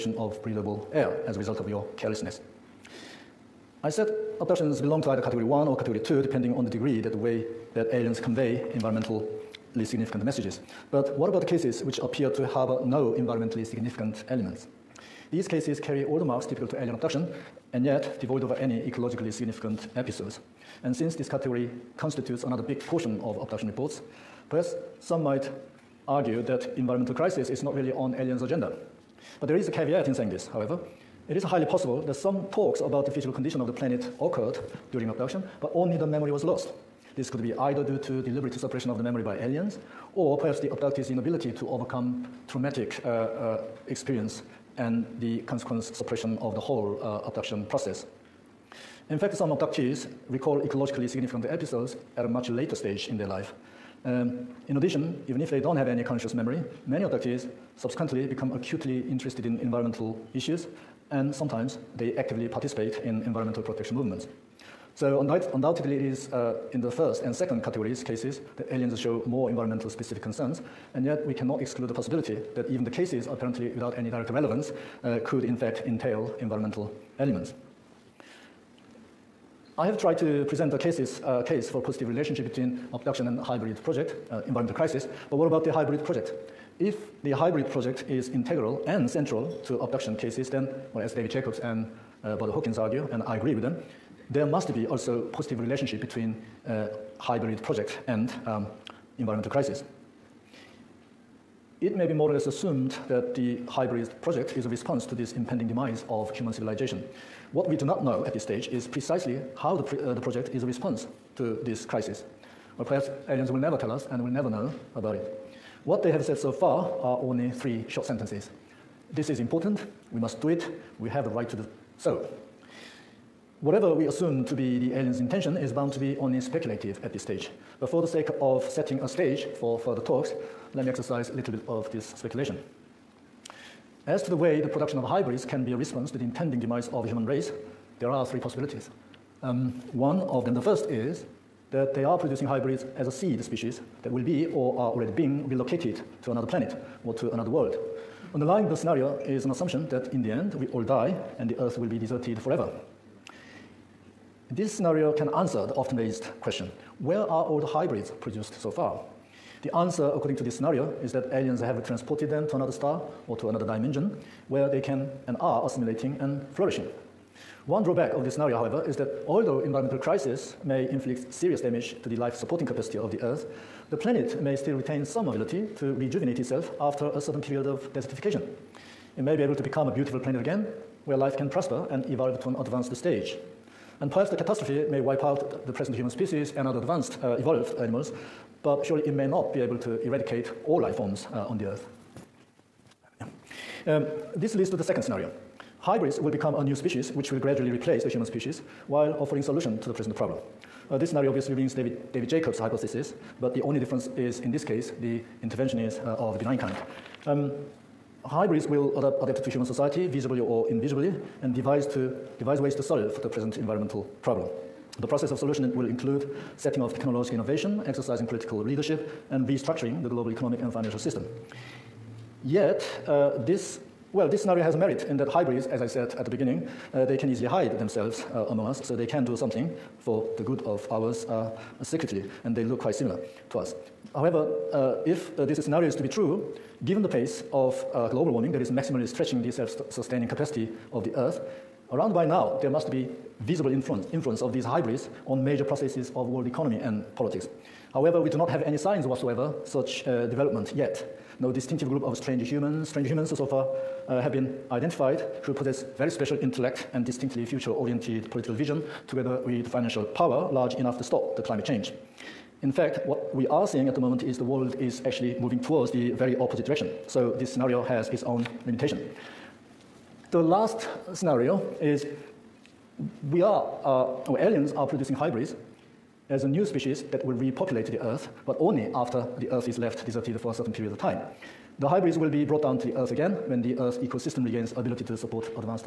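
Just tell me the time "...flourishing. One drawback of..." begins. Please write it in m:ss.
2:46.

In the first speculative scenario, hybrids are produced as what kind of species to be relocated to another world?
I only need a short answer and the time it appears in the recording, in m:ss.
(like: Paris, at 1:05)
A seed species, at 2:23.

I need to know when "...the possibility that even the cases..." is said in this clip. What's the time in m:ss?
1:11.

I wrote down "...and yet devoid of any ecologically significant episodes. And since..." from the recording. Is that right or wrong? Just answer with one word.
right.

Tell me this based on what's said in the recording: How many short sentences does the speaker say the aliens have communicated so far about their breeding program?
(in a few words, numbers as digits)
3.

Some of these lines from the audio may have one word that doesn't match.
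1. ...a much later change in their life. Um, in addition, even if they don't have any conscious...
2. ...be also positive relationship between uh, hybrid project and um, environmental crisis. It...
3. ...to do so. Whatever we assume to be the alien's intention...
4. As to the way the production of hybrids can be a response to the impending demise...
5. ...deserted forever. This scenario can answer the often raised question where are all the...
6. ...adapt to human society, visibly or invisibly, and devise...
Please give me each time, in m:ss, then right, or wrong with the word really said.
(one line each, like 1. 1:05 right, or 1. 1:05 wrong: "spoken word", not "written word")
1. 0:52 wrong: "stage", not "change"
2. 1:34 right
3. 2:01 right
4. 2:14 right
5. 2:31 right
6. 3:29 right.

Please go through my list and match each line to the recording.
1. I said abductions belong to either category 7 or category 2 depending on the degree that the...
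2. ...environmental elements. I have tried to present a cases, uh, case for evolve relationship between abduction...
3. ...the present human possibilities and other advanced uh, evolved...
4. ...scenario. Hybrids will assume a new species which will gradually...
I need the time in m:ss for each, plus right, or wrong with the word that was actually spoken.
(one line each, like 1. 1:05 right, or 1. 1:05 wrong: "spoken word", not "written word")
1. 0:03 wrong: "1", not "7"
2. 1:16 wrong: "positive", not "evolve"
3. 3:05 wrong: "species", not "possibilities"
4. 3:15 wrong: "become", not "assume".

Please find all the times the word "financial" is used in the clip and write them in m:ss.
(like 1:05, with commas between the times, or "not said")
3:40, 4:19.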